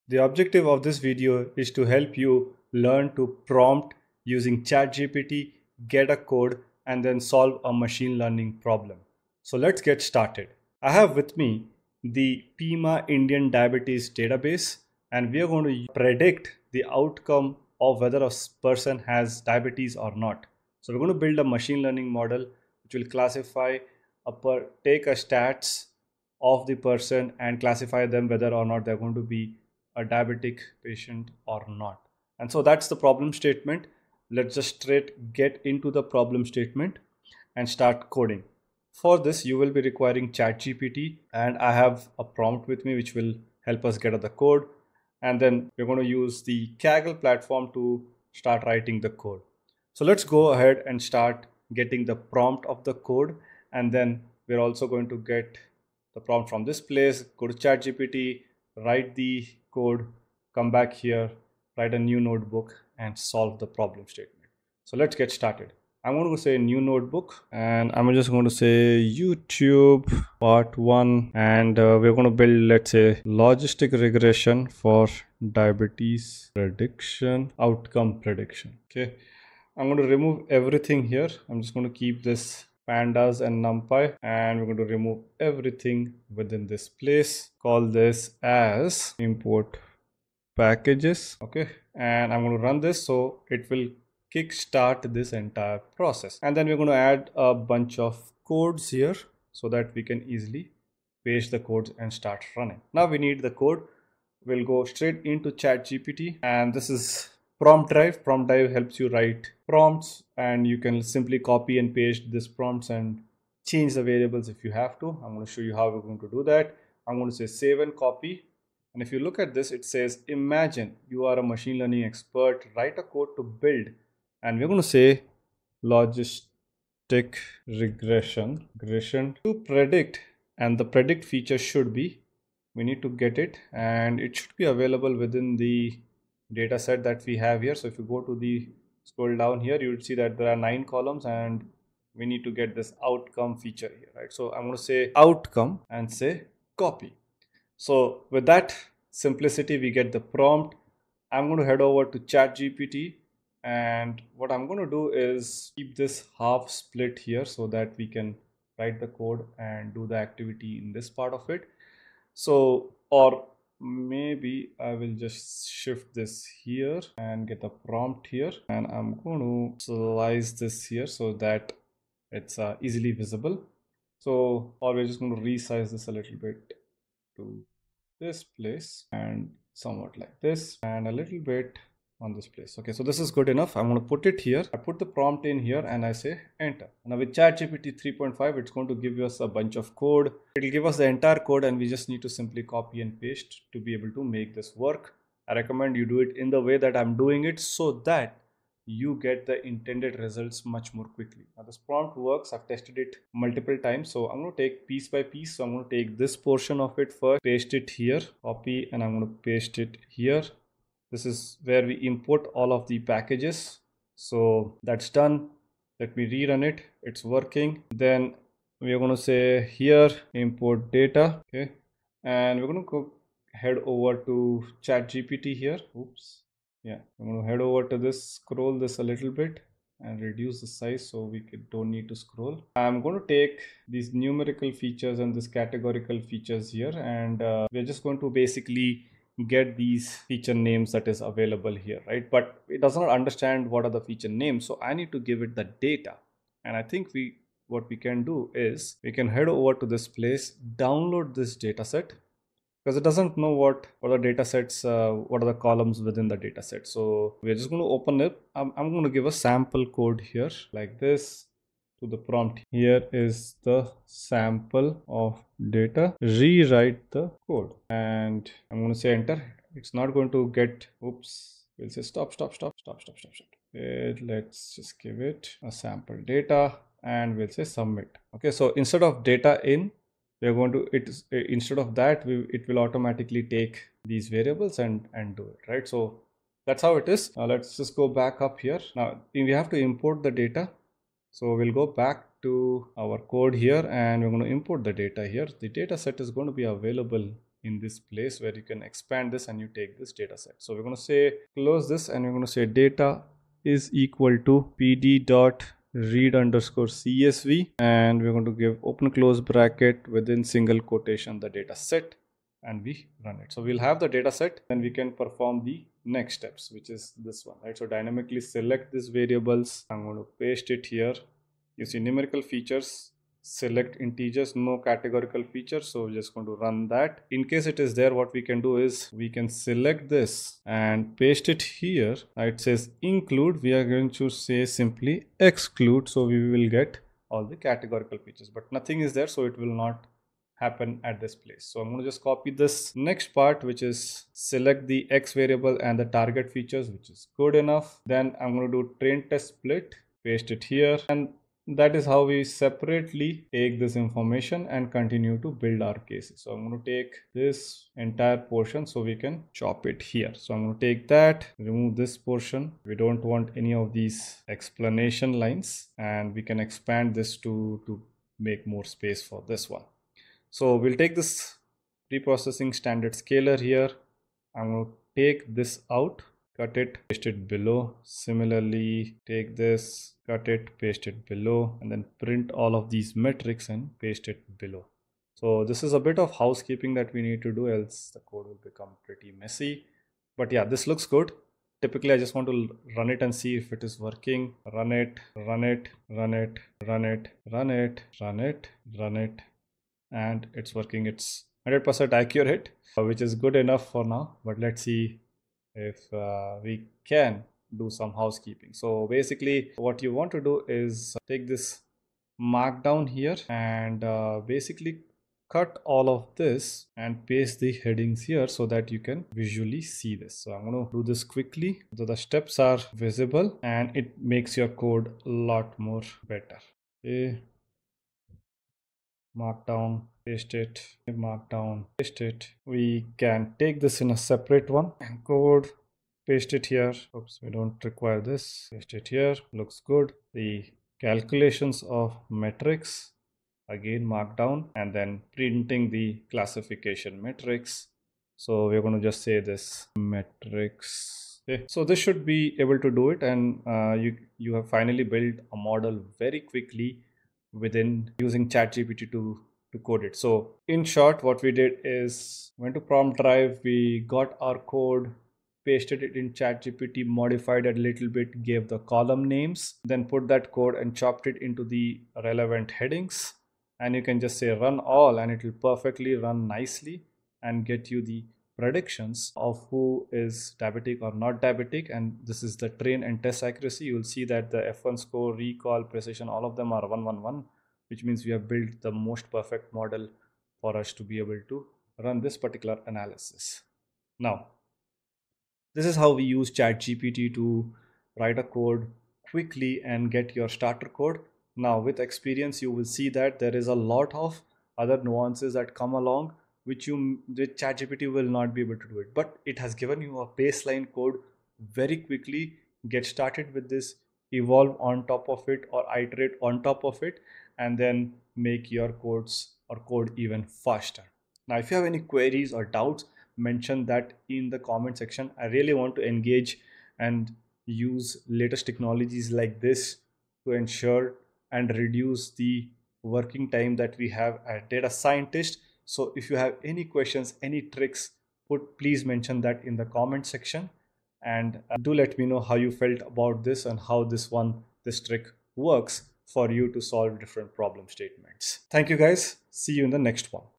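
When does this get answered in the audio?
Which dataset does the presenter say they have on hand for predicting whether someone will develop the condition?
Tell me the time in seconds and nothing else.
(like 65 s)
12 s.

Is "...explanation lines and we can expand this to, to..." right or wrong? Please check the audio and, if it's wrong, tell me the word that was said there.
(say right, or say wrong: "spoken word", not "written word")
right.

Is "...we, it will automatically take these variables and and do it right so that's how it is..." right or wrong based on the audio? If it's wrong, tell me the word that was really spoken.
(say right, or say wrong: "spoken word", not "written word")
right.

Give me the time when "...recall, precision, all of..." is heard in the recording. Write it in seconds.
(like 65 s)
485 s.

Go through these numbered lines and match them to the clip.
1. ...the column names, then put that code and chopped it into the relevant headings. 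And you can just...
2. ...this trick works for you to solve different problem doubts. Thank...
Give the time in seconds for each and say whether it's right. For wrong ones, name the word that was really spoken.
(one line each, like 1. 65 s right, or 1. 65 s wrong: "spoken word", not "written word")
1. 468 s right
2. 544 s wrong: "statements", not "doubts".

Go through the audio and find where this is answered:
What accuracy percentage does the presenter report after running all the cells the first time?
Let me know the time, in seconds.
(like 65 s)
401 s.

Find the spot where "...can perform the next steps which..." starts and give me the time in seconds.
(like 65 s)
314 s.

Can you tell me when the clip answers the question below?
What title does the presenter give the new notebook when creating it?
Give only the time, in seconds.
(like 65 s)
68 s.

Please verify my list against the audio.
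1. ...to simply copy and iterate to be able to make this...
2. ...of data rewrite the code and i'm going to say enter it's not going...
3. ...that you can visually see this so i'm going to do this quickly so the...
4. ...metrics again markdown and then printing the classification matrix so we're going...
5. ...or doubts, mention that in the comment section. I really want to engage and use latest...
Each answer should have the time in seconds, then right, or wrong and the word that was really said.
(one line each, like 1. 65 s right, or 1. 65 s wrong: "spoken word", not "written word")
1. 192 s wrong: "paste", not "iterate"
2. 265 s right
3. 418 s right
4. 442 s right
5. 522 s right.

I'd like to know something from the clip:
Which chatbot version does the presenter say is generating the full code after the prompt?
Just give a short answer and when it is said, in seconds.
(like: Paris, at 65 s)
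ChatGPT 3.5, at 187 s.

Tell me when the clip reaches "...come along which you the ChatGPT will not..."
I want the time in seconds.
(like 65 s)
505 s.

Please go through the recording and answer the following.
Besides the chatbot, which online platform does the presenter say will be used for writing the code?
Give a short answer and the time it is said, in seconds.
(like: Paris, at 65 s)
Kaggle, at 46 s.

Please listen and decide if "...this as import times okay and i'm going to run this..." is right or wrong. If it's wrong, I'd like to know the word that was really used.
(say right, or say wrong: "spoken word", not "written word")
wrong: "packages", not "times".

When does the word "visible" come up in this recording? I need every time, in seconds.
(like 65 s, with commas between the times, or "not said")
173 s, 422 s.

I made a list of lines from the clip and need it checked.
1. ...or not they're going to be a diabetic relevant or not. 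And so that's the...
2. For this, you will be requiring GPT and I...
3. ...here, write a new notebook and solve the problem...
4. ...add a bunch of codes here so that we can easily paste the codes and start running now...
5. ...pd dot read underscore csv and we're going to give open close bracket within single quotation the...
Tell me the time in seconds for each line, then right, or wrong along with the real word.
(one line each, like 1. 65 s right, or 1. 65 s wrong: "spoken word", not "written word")
1. 28 s wrong: "patient", not "relevant"
2. 38 s wrong: "ChatGPT", not "GPT"
3. 60 s right
4. 97 s right
5. 304 s right.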